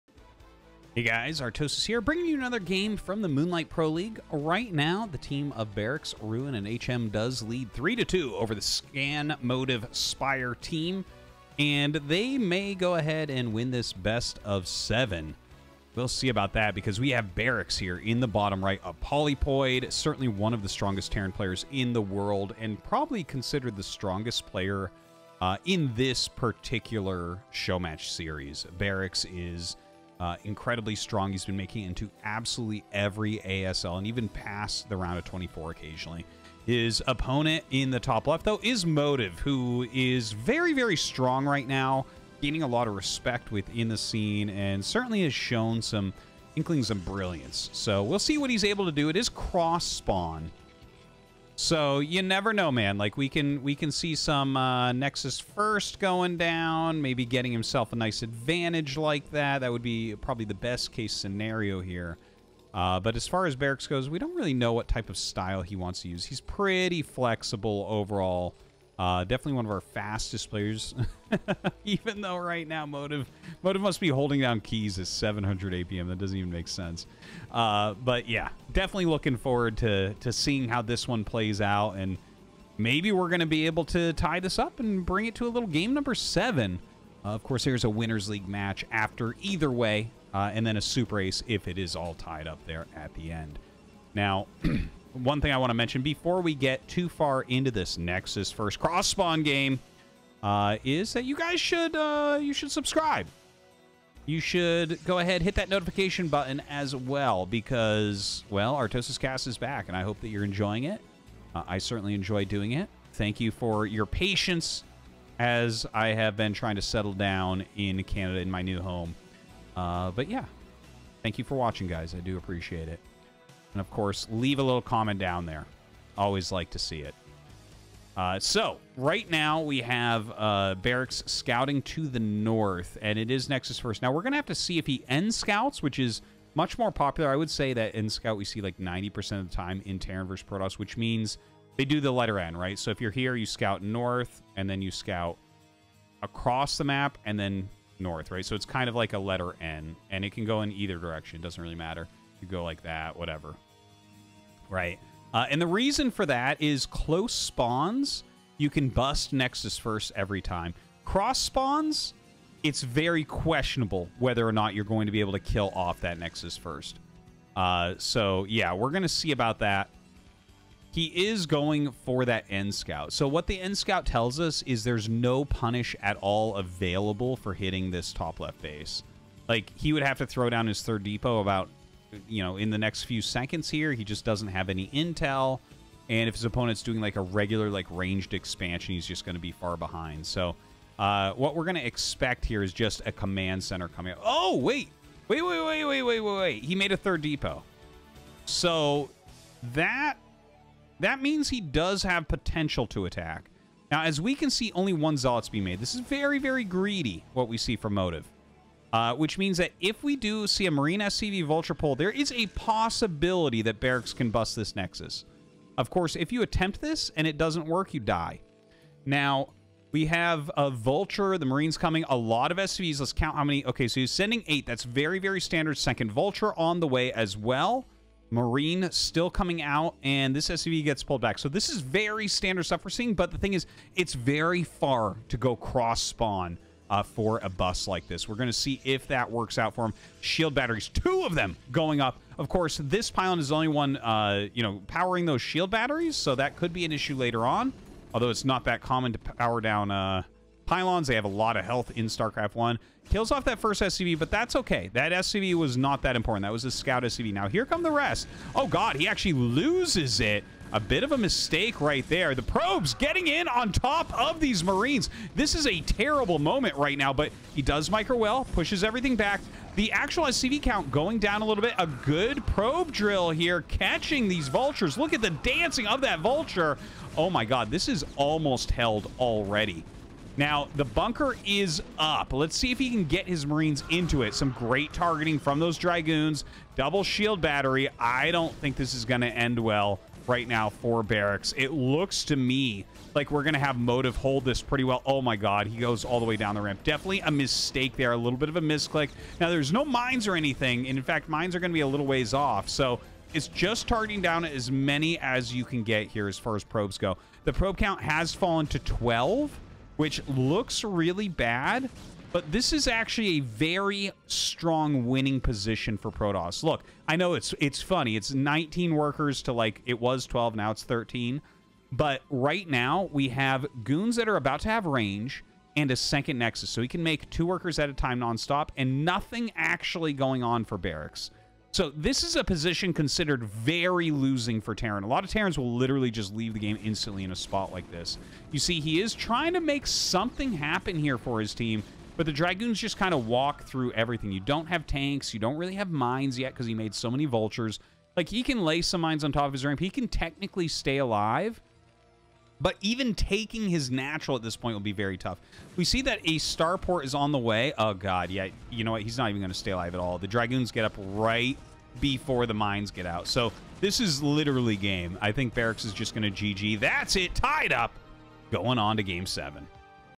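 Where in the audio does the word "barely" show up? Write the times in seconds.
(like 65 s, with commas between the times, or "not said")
not said.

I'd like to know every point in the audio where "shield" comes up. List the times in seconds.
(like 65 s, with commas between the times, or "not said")
240 s, 245 s, 287 s.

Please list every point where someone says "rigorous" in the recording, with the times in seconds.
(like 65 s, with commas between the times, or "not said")
not said.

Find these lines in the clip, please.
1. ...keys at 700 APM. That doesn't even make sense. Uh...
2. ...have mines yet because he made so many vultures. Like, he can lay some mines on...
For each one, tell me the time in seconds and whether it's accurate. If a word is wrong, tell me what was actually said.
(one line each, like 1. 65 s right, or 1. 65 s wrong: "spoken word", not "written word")
1. 74 s right
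2. 345 s right.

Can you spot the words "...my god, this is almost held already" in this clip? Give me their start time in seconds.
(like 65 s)
277 s.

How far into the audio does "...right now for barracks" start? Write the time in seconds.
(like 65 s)
290 s.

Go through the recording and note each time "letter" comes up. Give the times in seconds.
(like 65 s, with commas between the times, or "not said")
142 s, 149 s.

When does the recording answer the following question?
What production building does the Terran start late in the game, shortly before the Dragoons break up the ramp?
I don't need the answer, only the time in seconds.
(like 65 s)
356 s.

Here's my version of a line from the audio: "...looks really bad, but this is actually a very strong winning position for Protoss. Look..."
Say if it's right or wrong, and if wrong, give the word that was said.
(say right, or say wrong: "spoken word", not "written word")
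right.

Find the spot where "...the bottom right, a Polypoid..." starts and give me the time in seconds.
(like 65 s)
18 s.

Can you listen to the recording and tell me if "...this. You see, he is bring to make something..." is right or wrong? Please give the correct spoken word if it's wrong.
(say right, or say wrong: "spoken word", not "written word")
wrong: "trying", not "bring".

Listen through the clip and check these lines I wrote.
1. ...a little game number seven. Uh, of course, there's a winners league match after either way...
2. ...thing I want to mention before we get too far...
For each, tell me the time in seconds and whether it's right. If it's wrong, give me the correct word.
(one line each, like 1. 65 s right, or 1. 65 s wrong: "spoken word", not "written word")
1. 85 s right
2. 95 s right.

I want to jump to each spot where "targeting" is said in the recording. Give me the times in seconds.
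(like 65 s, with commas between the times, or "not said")
284 s, 303 s.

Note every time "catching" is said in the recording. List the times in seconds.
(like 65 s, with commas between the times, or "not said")
273 s.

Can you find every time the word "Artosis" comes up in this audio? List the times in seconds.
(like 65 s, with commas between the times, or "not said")
1 s, 108 s.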